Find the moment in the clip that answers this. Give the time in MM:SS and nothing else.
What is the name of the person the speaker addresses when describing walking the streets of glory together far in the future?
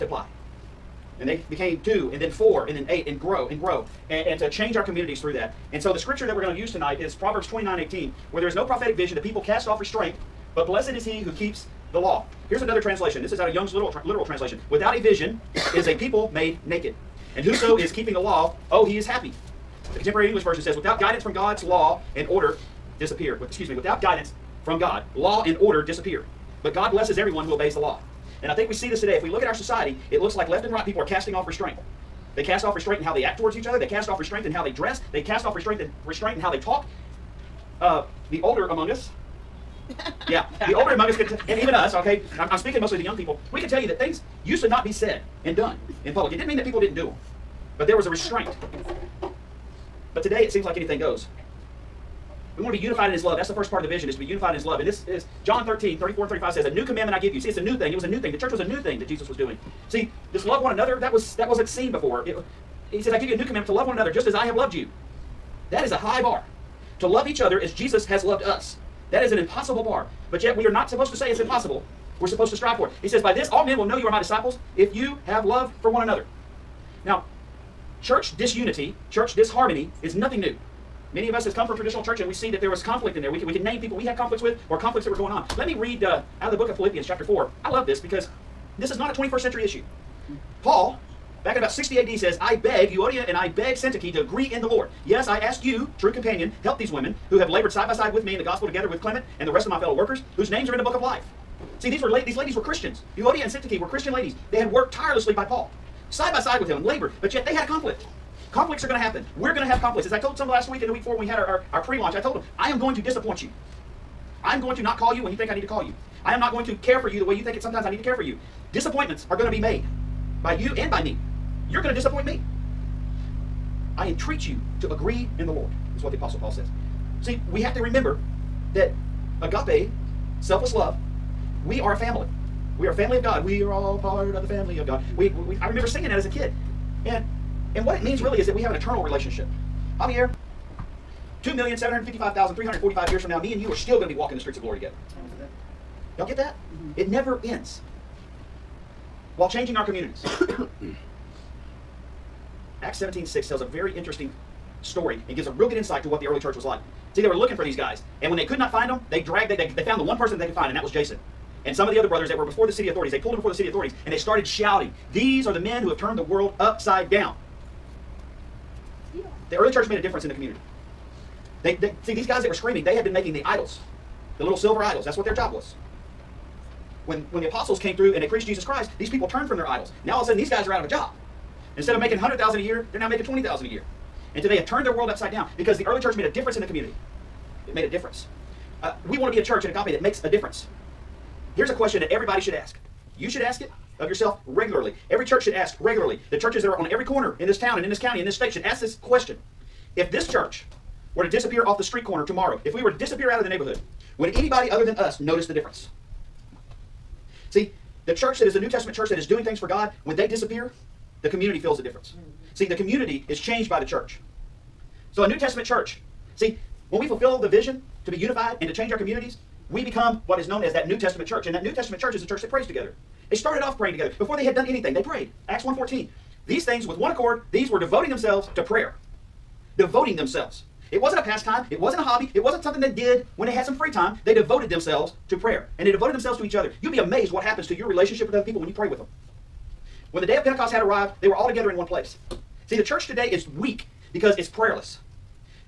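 02:19.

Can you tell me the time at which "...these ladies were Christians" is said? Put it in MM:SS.
01:42.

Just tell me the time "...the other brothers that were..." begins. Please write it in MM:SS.
02:41.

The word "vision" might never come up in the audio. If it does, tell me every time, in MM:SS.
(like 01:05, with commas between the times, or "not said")
00:08, 00:15, 00:53, 03:37.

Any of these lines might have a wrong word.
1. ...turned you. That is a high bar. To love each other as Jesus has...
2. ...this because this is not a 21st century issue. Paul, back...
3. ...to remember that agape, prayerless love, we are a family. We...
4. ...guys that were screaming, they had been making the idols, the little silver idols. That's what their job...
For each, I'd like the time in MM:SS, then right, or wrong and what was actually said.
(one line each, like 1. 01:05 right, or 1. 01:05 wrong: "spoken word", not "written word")
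1. 01:04 wrong: "loved", not "turned"
2. 01:27 right
3. 02:07 wrong: "selfless", not "prayerless"
4. 02:52 right.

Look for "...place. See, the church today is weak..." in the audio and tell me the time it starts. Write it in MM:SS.
04:01.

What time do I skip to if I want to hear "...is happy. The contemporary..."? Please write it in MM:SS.
00:18.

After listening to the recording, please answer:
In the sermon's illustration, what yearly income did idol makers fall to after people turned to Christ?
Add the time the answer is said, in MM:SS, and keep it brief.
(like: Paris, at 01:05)
20,000, at 03:03.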